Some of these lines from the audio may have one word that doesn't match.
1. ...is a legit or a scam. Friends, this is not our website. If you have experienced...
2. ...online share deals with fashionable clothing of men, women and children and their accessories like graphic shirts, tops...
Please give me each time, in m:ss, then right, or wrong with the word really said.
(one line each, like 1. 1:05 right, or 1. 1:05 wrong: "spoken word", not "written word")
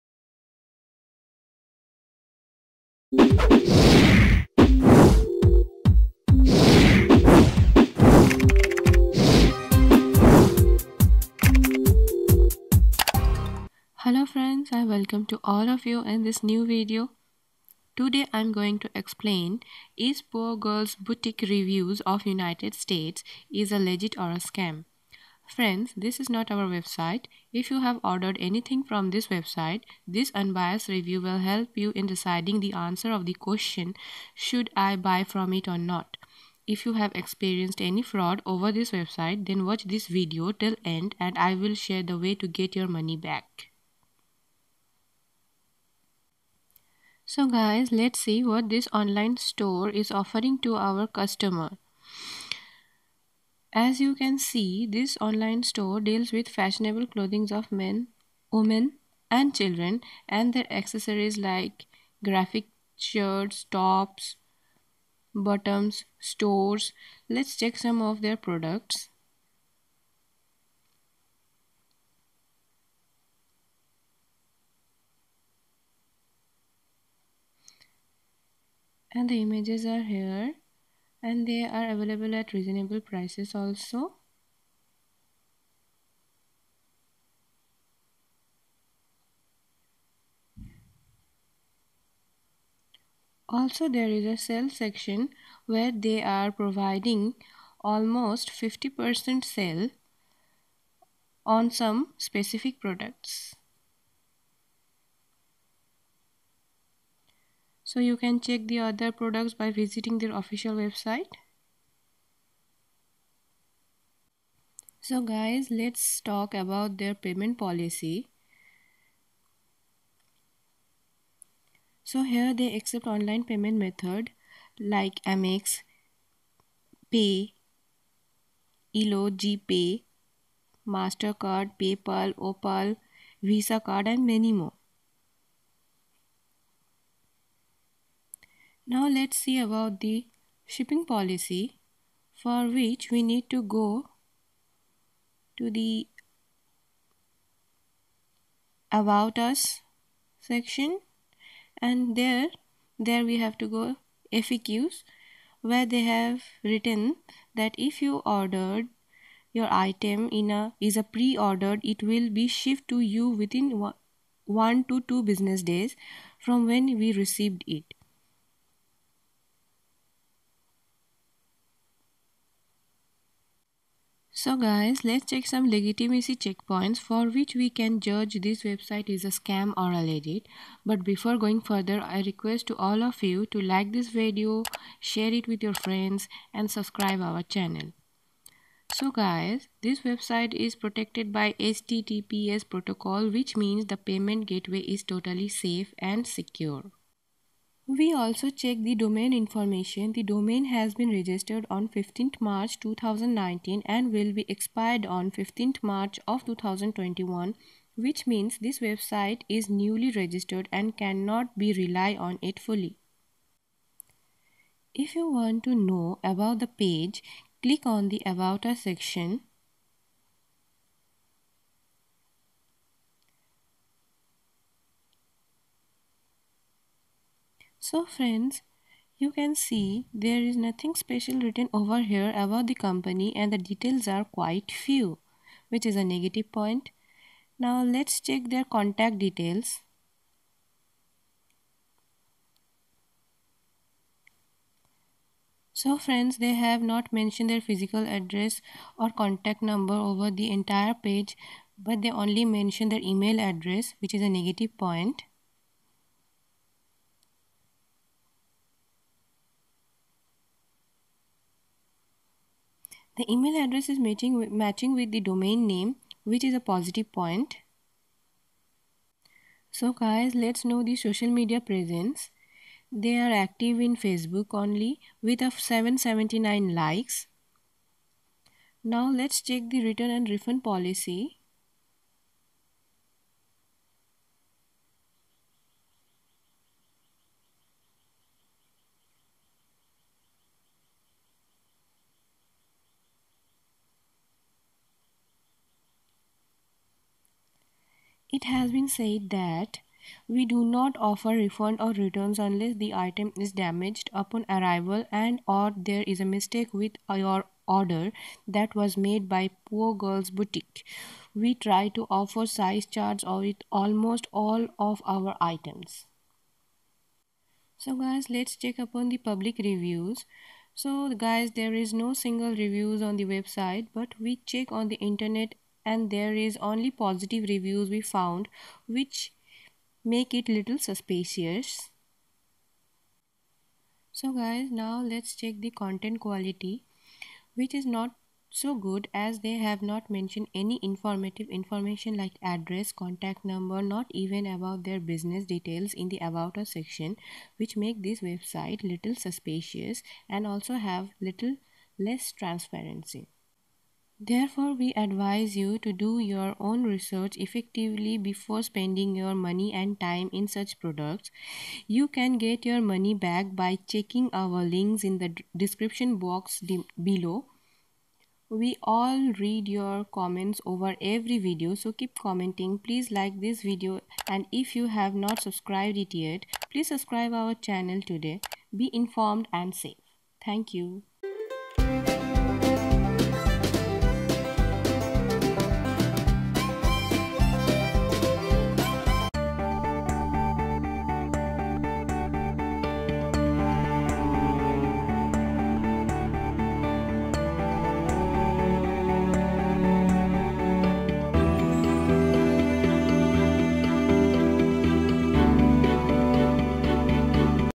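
1. 0:23 wrong: "ordered", not "experienced"
2. 0:55 wrong: "store", not "share".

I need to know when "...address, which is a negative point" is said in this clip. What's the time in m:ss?
4:13.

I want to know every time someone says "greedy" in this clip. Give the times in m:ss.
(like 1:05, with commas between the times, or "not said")
not said.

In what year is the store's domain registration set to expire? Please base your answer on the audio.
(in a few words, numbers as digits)
2021.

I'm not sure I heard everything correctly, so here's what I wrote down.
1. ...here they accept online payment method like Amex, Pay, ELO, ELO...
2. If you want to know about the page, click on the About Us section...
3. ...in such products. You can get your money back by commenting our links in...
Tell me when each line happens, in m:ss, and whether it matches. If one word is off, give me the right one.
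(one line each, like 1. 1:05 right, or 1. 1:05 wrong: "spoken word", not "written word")
1. 2:02 wrong: "GPay", not "ELO"
2. 3:34 right
3. 6:00 wrong: "checking", not "commenting".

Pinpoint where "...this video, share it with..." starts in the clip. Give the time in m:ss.
3:03.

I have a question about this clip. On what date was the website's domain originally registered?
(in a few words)
15 March 2019.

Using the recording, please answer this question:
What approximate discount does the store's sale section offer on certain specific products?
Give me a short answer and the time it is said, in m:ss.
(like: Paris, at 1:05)
50%, at 1:37.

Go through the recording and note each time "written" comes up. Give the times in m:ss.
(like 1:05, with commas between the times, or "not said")
2:36, 3:51.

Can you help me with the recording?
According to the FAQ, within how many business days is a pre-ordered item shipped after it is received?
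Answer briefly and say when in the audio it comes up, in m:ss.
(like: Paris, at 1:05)
1 to 2 business days, at 2:44.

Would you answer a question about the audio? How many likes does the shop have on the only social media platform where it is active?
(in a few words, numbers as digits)
779.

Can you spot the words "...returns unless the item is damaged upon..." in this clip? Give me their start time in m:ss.
5:01.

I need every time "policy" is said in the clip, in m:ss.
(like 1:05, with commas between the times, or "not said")
1:57, 2:21, 4:40.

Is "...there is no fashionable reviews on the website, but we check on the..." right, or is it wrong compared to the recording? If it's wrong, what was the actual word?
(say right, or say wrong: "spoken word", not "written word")
wrong: "single", not "fashionable".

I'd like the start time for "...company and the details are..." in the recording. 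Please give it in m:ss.
3:52.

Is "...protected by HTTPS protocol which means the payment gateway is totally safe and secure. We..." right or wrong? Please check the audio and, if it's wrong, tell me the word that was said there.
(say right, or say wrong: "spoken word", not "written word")
right.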